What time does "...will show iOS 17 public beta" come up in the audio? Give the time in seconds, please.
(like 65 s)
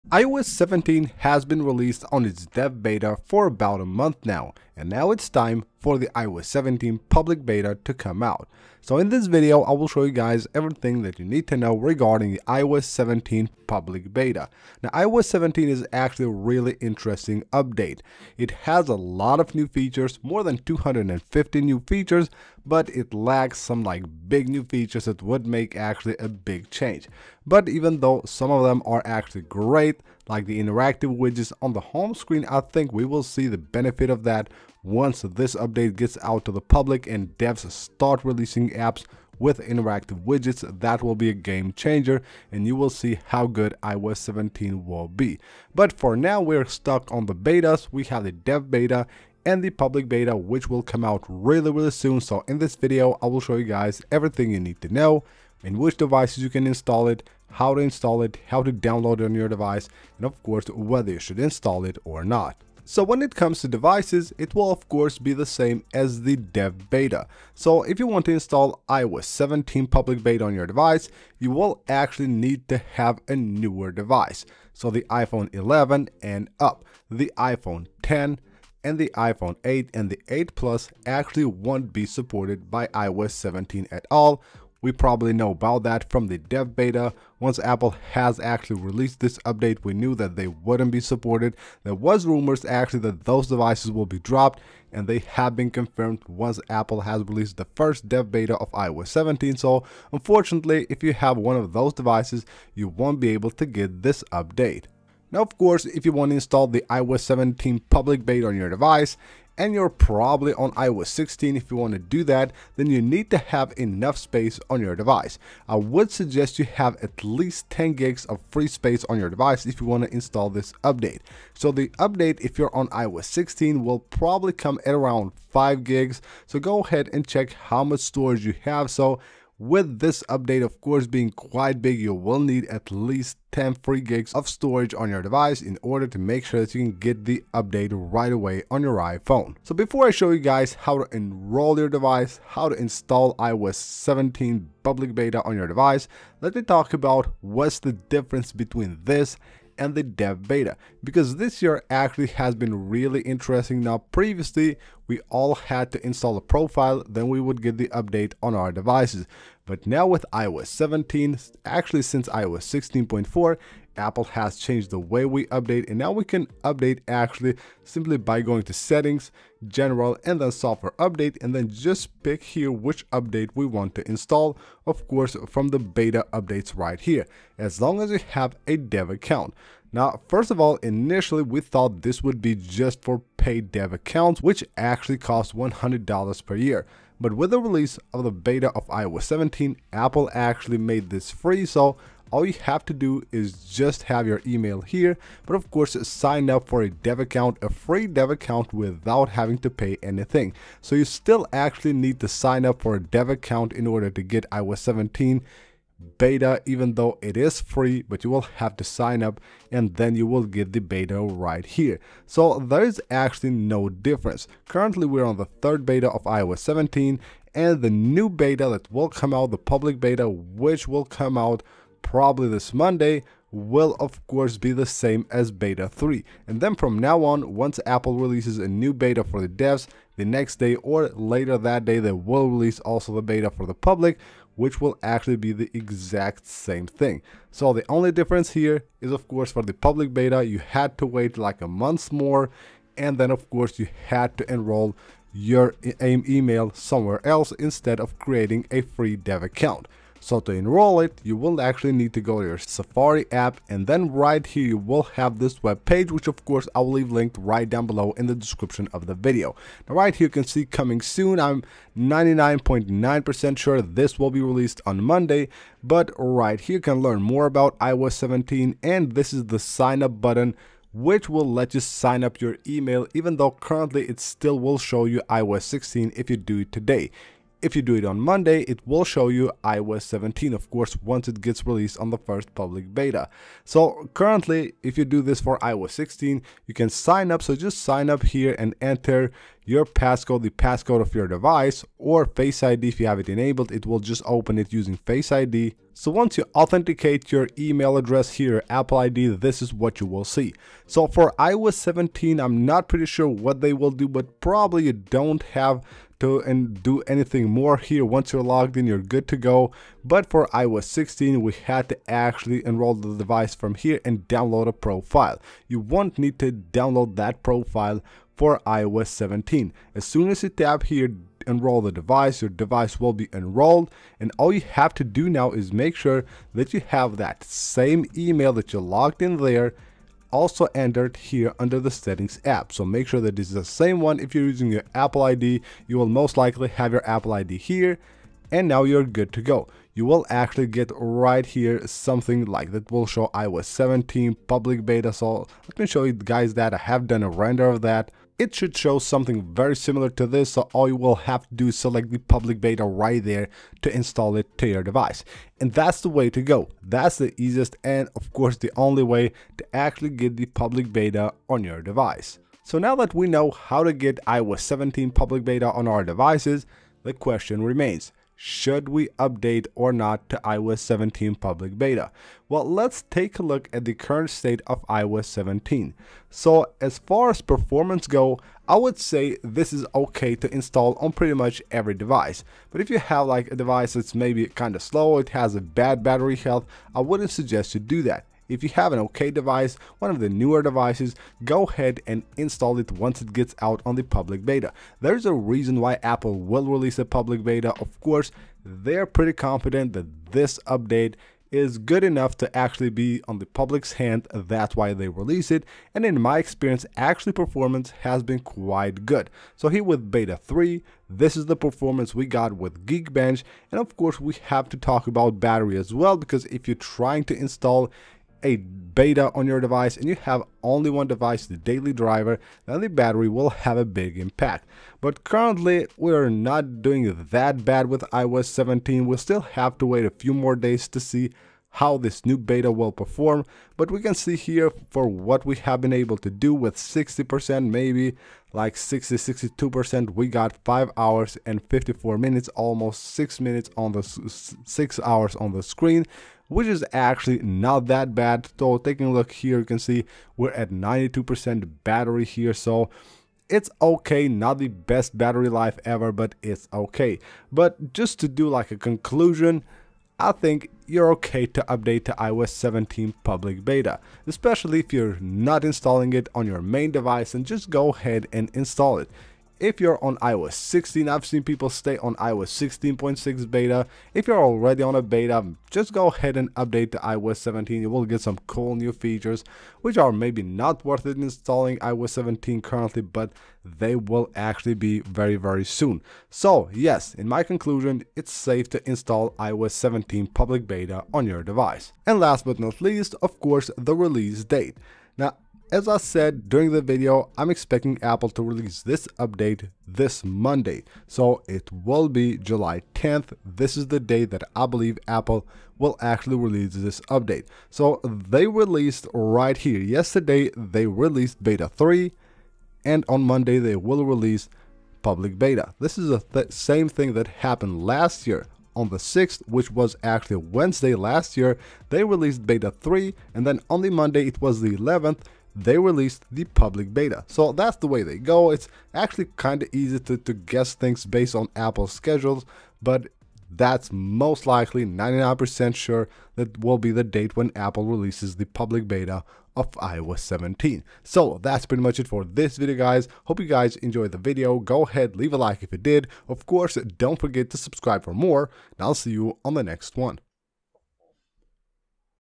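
342 s.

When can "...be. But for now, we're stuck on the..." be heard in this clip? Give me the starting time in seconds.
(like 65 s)
45 s.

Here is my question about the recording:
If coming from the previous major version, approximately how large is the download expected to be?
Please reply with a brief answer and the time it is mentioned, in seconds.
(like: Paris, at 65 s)
5 gigs, at 124 s.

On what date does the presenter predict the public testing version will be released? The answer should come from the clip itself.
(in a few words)
July 10th.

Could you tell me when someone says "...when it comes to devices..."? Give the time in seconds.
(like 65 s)
63 s.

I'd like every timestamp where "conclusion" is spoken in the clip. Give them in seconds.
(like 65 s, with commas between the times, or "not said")
458 s, 487 s.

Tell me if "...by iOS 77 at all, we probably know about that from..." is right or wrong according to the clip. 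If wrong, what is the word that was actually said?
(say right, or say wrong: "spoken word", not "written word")
wrong: "17", not "77".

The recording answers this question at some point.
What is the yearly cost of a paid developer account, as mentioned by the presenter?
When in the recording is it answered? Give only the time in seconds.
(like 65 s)
185 s.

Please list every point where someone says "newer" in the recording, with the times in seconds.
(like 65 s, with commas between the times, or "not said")
73 s, 390 s.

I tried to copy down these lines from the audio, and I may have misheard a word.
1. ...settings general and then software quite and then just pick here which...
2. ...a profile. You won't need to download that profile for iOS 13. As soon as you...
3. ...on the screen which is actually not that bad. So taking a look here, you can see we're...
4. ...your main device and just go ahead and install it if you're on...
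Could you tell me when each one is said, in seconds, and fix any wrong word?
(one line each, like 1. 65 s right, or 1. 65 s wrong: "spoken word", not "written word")
1. 168 s wrong: "update", not "quite"
2. 314 s wrong: "17", not "13"
3. 445 s right
4. 466 s right.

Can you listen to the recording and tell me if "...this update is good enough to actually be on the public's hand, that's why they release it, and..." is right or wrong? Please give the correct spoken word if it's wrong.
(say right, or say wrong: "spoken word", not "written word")
right.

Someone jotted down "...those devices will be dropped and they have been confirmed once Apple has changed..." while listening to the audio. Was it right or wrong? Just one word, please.
wrong.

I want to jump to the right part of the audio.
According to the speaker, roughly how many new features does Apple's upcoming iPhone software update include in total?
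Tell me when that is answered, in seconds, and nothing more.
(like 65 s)
20 s.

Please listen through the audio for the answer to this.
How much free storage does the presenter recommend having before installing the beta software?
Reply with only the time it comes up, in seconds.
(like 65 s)
117 s.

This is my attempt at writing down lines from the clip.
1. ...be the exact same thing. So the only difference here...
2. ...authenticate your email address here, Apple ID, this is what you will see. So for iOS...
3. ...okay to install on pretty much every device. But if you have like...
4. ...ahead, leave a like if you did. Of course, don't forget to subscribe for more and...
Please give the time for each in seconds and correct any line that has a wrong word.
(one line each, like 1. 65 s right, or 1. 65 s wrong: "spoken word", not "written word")
1. 235 s right
2. 296 s right
3. 379 s right
4. 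544 s right.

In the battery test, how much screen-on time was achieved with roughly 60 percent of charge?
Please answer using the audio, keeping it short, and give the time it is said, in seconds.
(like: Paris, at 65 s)
5 hours 54 minutes, at 440 s.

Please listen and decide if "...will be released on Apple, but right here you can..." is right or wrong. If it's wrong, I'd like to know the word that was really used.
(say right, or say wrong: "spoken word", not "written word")
wrong: "Monday", not "Apple".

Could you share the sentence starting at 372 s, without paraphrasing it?
Well, let's take a look at the current state of iOS 17.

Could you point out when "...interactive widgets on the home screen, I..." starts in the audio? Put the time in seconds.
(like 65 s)
30 s.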